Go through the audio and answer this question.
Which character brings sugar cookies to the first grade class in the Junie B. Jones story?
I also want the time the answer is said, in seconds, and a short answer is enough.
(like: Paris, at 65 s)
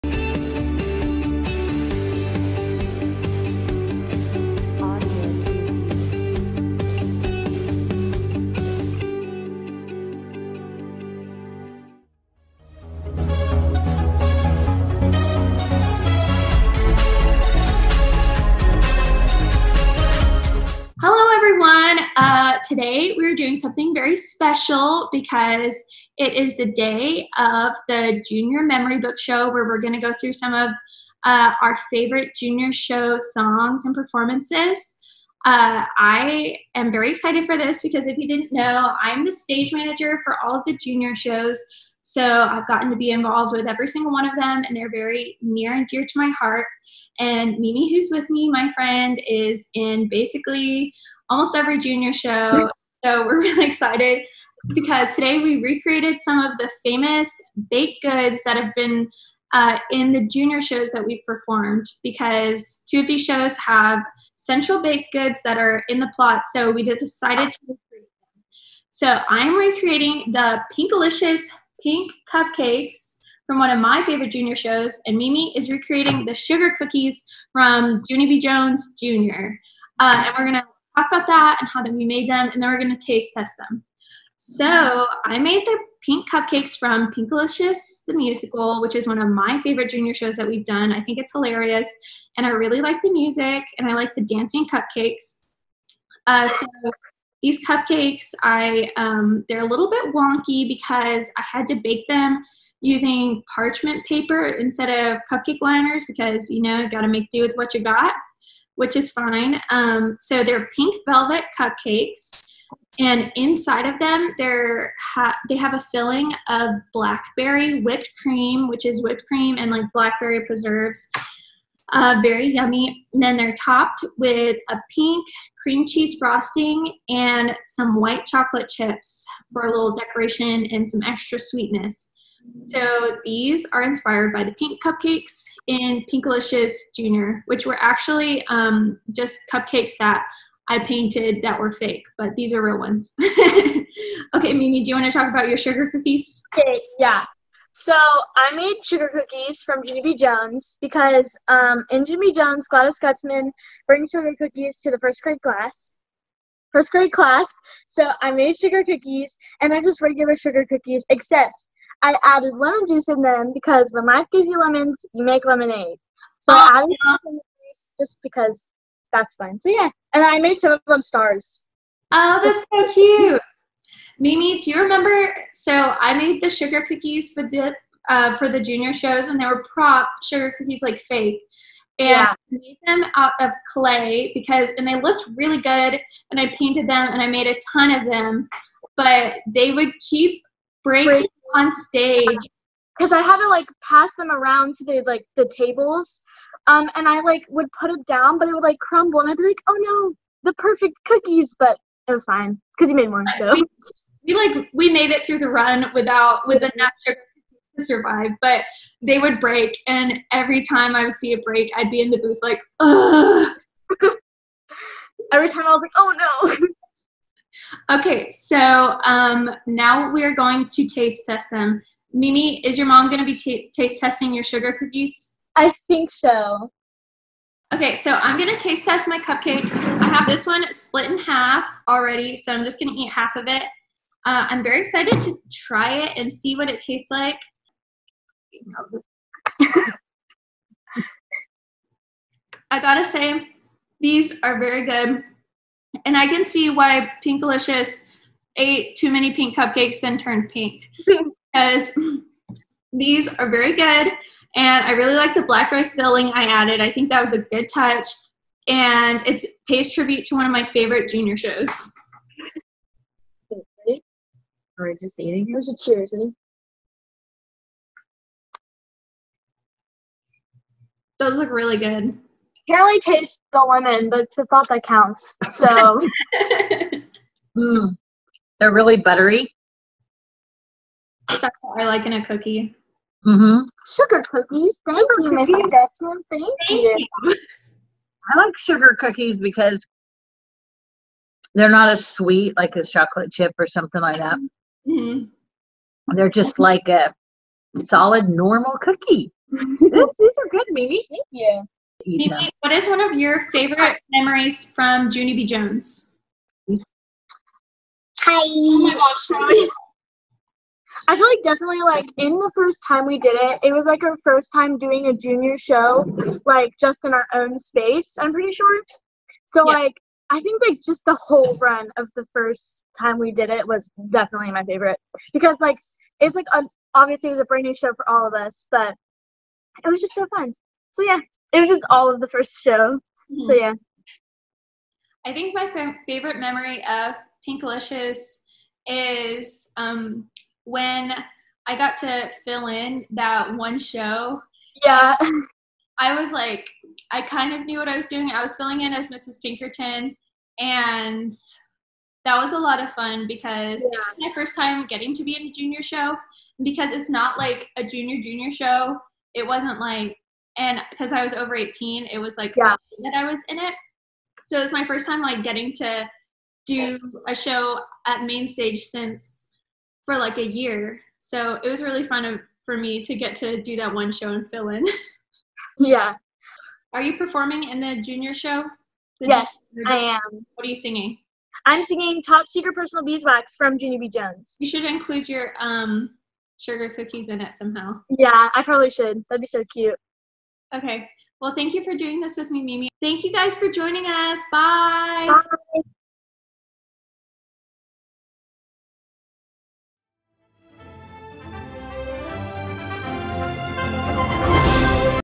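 Gladys Gutzman, at 152 s.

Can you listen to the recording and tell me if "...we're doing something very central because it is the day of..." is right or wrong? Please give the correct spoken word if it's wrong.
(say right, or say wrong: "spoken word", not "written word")
wrong: "special", not "central".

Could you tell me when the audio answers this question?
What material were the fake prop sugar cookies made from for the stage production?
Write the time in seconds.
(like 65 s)
183 s.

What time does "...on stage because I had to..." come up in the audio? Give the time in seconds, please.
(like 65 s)
191 s.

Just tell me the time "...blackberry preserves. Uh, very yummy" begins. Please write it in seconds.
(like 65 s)
119 s.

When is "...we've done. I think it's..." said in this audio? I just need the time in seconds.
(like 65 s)
90 s.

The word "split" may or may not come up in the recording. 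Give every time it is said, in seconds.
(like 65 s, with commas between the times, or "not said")
230 s.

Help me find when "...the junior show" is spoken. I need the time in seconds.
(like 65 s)
377 s.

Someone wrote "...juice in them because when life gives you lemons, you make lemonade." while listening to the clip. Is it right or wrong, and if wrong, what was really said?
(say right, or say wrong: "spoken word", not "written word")
right.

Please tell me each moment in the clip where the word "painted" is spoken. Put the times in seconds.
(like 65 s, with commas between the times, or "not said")
140 s, 186 s.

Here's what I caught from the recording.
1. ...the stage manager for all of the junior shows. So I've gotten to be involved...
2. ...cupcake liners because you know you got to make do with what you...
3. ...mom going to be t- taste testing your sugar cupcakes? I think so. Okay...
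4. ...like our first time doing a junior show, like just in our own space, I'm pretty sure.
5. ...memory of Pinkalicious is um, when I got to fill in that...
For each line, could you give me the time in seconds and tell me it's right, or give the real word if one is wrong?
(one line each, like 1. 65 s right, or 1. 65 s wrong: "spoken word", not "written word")
1. 39 s right
2. 105 s right
3. 222 s wrong: "cookies", not "cupcakes"
4. 313 s right
5. 336 s right.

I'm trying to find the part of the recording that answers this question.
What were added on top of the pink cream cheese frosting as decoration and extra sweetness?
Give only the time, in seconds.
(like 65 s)
127 s.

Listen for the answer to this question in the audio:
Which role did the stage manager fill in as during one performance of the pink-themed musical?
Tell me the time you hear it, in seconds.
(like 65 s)
349 s.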